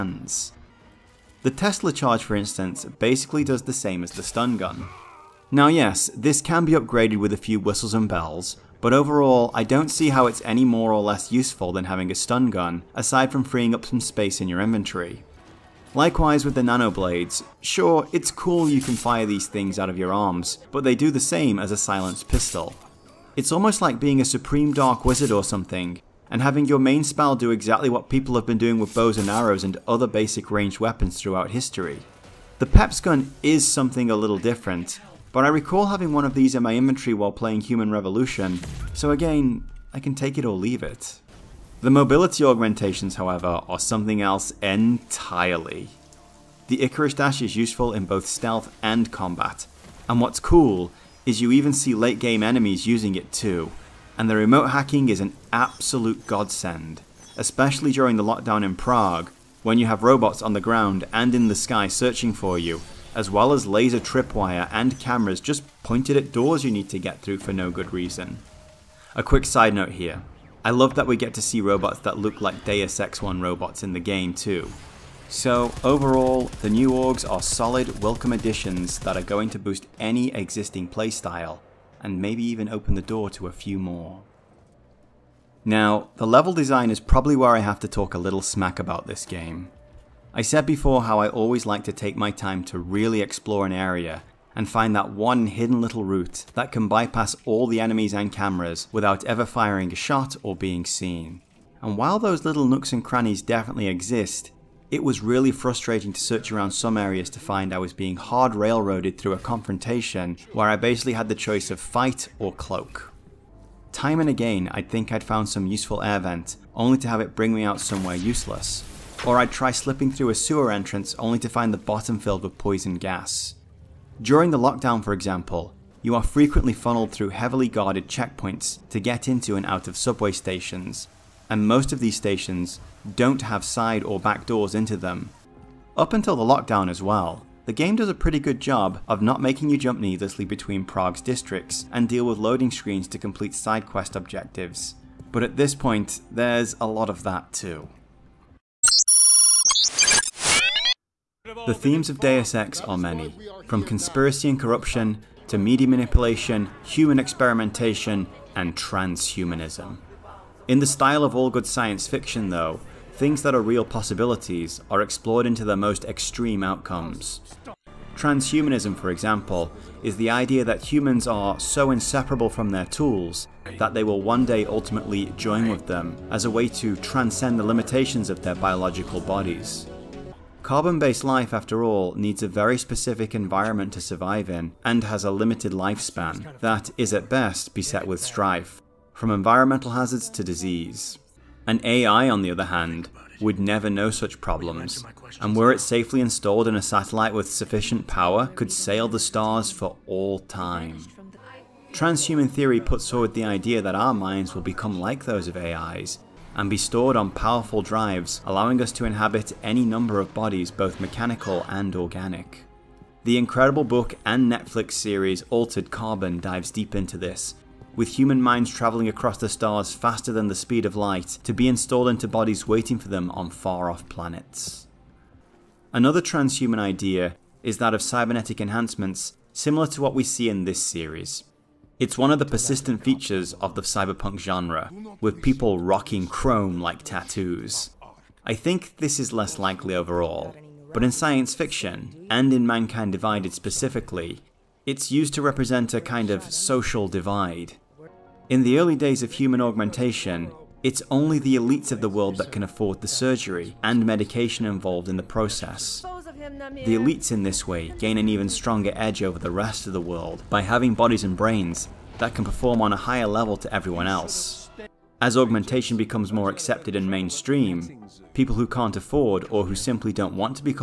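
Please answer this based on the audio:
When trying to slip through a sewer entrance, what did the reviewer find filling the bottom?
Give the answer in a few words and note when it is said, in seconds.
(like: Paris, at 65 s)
Poison gas, at 122 s.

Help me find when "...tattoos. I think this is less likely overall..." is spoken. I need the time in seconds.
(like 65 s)
237 s.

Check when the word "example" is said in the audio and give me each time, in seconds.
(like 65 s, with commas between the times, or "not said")
125 s, 169 s.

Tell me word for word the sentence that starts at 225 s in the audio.
Another transhuman idea is that of cybernetic enhancements, similar to what we see in this series.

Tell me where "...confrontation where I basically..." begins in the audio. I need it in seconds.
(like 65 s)
109 s.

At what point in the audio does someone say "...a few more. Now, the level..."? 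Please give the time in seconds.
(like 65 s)
83 s.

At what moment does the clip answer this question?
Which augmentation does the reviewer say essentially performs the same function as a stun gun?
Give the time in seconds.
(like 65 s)
1 s.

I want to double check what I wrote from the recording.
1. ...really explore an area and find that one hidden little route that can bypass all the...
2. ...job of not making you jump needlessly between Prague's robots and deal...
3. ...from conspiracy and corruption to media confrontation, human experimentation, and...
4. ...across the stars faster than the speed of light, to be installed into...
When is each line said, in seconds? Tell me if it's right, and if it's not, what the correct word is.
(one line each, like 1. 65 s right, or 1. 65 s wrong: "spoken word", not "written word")
1. 92 s right
2. 138 s wrong: "districts", not "robots"
3. 153 s wrong: "manipulation", not "confrontation"
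4. 219 s right.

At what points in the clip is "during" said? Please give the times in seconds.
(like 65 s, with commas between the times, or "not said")
57 s, 124 s.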